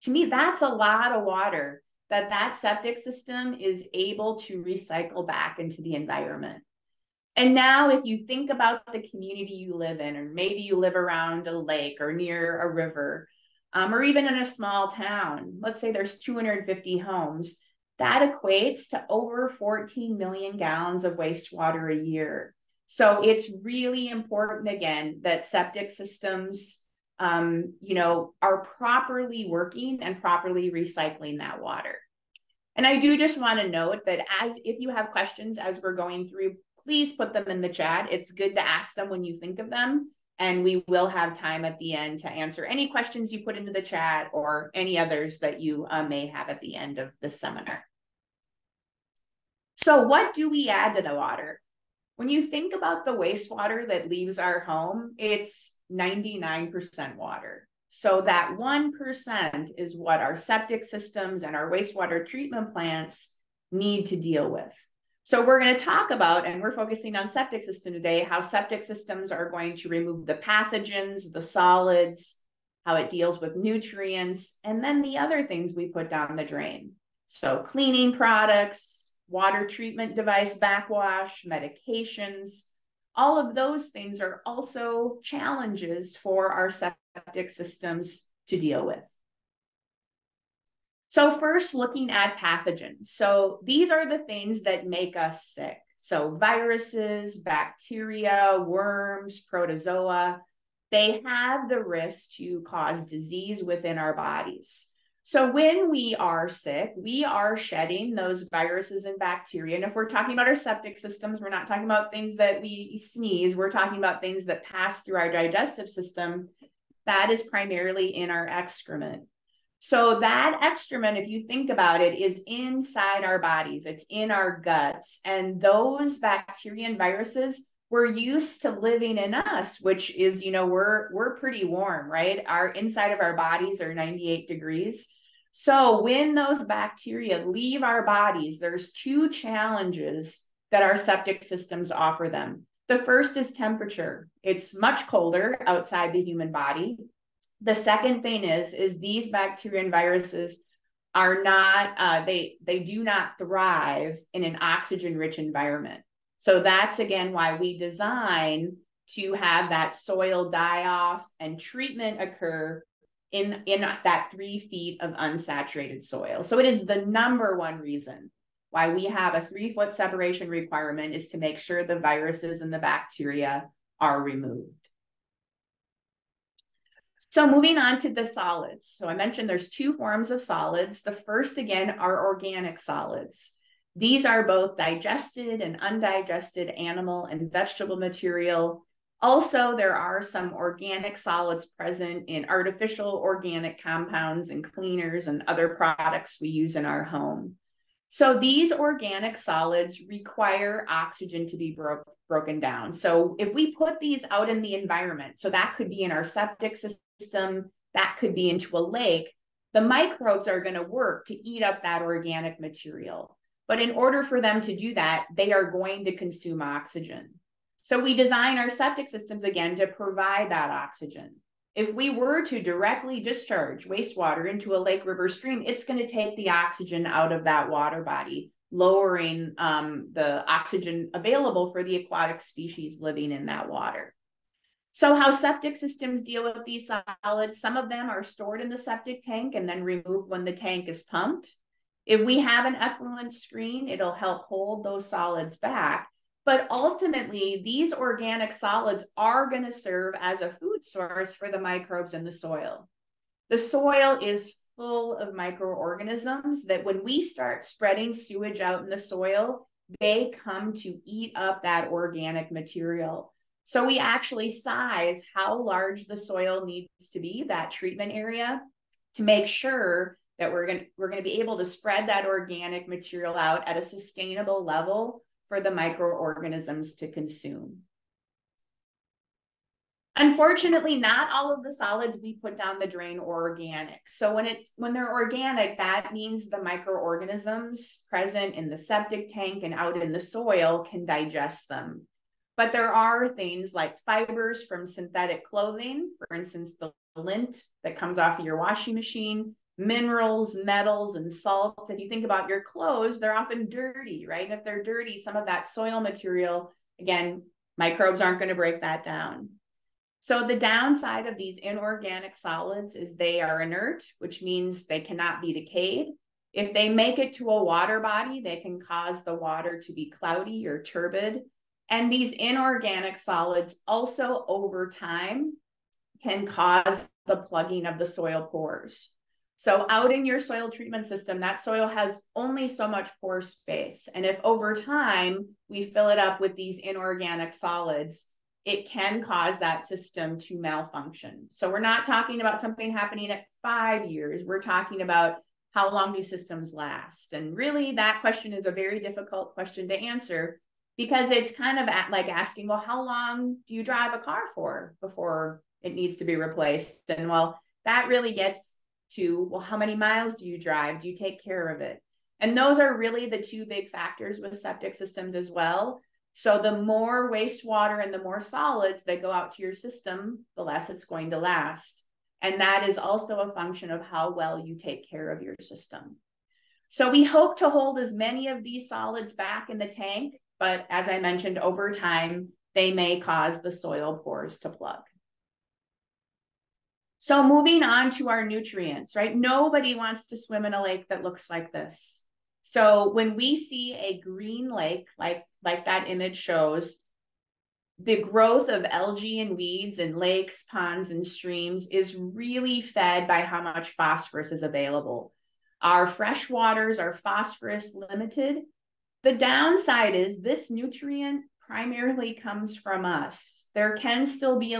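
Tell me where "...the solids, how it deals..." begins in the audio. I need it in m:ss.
1:11.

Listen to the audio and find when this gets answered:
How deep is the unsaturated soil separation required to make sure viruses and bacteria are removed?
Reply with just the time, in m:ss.
2:44.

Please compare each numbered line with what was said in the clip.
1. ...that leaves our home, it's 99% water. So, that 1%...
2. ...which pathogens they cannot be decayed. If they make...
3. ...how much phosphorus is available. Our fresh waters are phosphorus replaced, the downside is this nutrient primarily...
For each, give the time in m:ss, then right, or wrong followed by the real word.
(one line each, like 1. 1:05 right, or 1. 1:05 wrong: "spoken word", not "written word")
1. 0:53 right
2. 5:14 wrong: "means", not "pathogens"
3. 6:43 wrong: "limited", not "replaced".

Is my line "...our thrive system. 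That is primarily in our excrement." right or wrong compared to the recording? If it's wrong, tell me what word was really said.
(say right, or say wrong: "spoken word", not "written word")
wrong: "digestive", not "thrive".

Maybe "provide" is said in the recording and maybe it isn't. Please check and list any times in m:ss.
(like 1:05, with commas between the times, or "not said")
3:39.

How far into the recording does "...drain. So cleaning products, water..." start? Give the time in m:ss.
1:16.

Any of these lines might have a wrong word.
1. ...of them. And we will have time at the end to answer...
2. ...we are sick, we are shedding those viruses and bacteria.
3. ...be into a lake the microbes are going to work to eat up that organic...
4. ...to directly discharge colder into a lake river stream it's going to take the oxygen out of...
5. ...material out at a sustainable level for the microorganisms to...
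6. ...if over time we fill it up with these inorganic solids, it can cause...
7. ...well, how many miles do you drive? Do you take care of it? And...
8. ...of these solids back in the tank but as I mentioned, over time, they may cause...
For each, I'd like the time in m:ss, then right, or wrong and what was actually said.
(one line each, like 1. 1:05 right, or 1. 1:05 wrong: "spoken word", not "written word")
1. 0:39 right
2. 1:45 right
3. 3:28 right
4. 3:42 wrong: "wastewater", not "colder"
5. 4:32 right
6. 5:34 right
7. 5:59 right
8. 6:18 right.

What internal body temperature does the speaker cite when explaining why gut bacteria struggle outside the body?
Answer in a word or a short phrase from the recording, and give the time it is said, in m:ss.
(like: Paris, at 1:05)
98 degrees, at 2:13.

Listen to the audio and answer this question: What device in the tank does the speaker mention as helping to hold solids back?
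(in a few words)
effluent screen.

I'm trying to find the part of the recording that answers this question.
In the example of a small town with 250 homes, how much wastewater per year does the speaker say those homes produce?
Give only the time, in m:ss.
0:19.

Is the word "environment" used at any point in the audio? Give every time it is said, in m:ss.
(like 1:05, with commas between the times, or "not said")
0:05, 2:35, 3:24.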